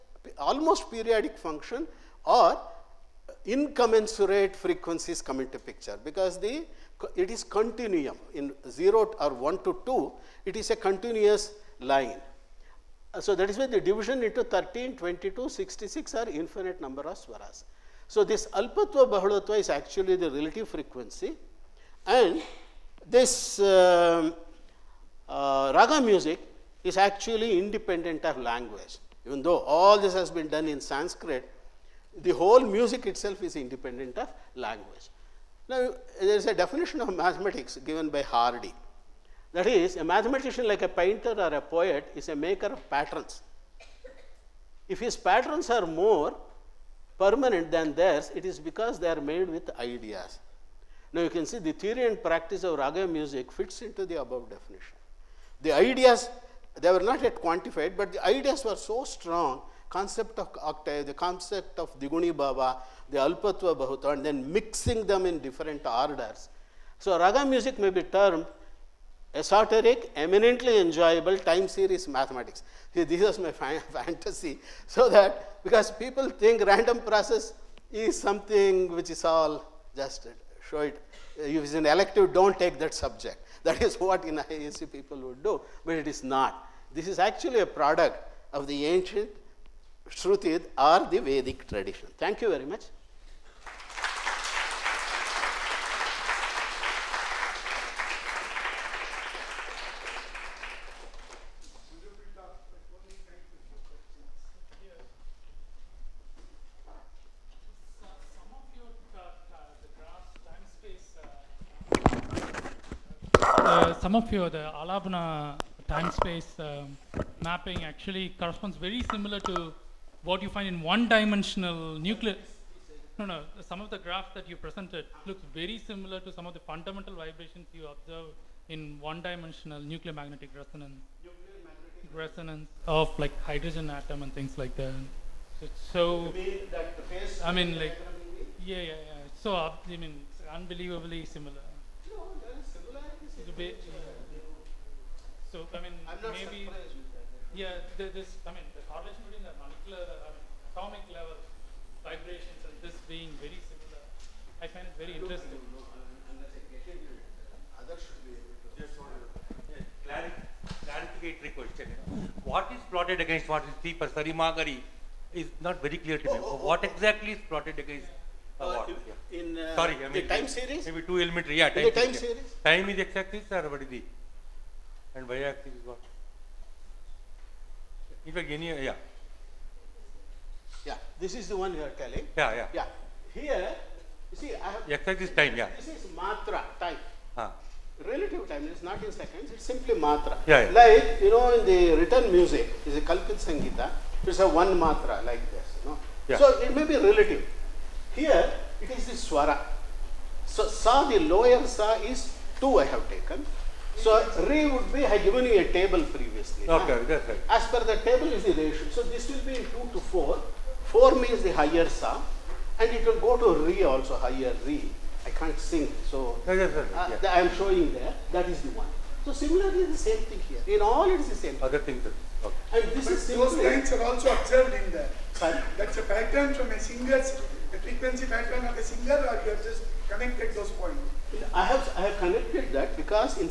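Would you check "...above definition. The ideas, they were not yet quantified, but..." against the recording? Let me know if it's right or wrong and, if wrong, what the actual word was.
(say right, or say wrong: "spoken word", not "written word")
right.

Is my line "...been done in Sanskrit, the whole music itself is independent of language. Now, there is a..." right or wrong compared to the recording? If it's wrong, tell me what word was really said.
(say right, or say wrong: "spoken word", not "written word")
right.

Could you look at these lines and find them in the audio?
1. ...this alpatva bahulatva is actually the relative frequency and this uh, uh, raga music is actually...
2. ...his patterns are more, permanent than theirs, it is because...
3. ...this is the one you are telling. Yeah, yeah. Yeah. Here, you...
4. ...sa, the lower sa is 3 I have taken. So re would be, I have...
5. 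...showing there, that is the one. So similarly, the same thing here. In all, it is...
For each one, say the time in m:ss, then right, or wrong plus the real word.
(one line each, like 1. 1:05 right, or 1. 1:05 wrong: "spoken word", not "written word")
1. 0:18 right
2. 0:44 right
3. 3:01 right
4. 3:20 wrong: "2", not "3"
5. 3:37 right.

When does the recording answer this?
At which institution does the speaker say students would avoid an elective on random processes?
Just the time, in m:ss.
1:24.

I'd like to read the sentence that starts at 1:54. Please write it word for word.
some of your the Alapana time space um, mapping actually corresponds very similar to what you find in one dimensional nucleus.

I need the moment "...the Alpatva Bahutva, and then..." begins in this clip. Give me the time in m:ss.
1:03.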